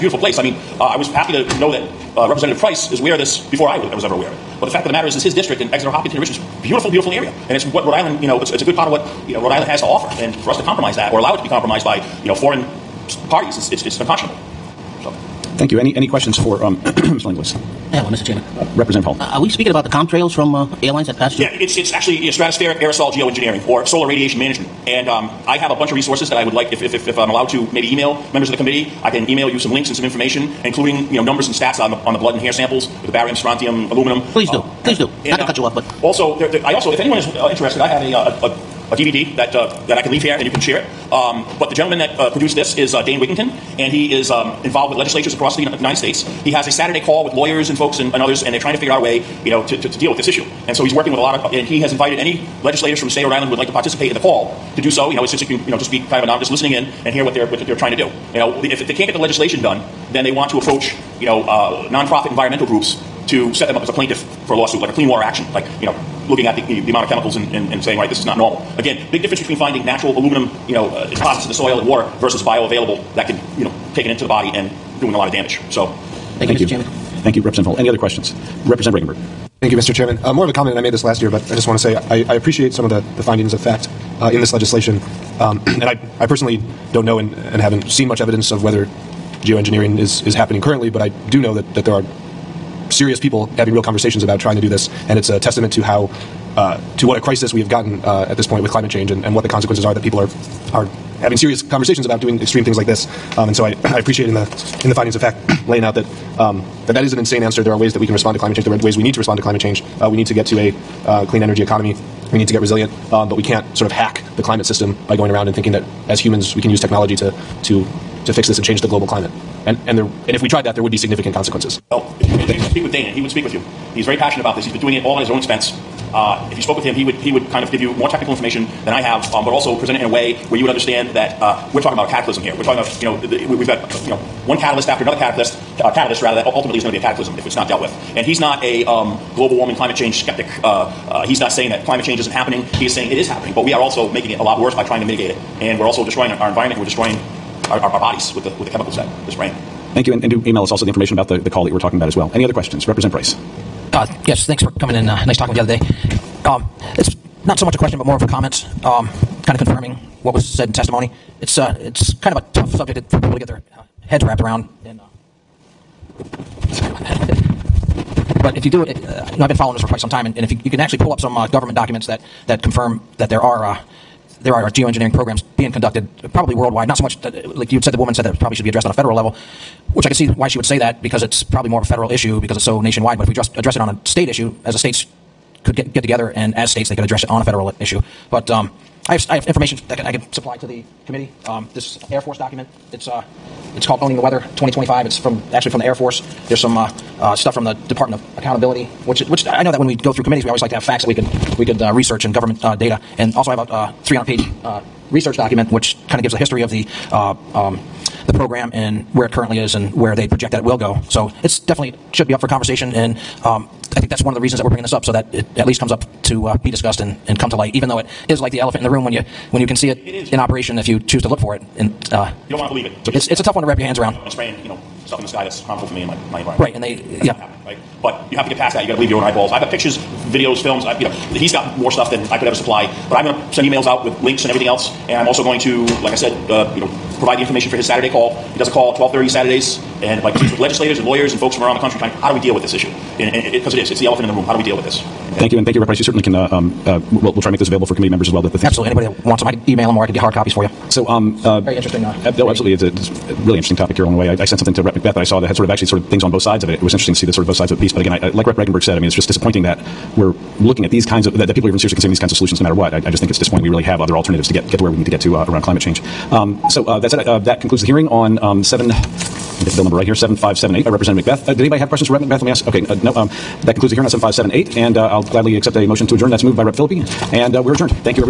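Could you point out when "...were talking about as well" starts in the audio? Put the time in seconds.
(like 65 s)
151 s.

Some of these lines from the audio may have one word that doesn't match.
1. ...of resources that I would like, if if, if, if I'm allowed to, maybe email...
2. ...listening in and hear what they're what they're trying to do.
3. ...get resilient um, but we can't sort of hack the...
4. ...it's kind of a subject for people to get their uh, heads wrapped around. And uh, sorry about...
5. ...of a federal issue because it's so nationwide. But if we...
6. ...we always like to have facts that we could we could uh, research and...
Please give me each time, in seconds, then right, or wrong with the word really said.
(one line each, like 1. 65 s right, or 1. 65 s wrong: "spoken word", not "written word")
1. 25 s right
2. 56 s right
3. 112 s right
4. 161 s right
5. 181 s right
6. 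200 s right.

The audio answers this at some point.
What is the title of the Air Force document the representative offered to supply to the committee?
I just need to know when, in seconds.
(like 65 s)
194 s.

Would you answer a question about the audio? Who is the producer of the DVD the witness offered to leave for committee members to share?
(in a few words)
Dane Wigington.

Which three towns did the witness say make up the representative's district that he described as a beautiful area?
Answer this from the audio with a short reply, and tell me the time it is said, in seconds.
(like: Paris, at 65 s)
Exeter, Hopkinton, and Richmond, at 5 s.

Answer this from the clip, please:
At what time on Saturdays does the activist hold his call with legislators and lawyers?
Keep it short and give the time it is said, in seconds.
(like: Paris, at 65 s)
12:30, at 238 s.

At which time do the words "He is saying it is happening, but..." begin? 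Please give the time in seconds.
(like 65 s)
142 s.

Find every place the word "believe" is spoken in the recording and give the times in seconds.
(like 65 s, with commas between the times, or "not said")
222 s, 228 s.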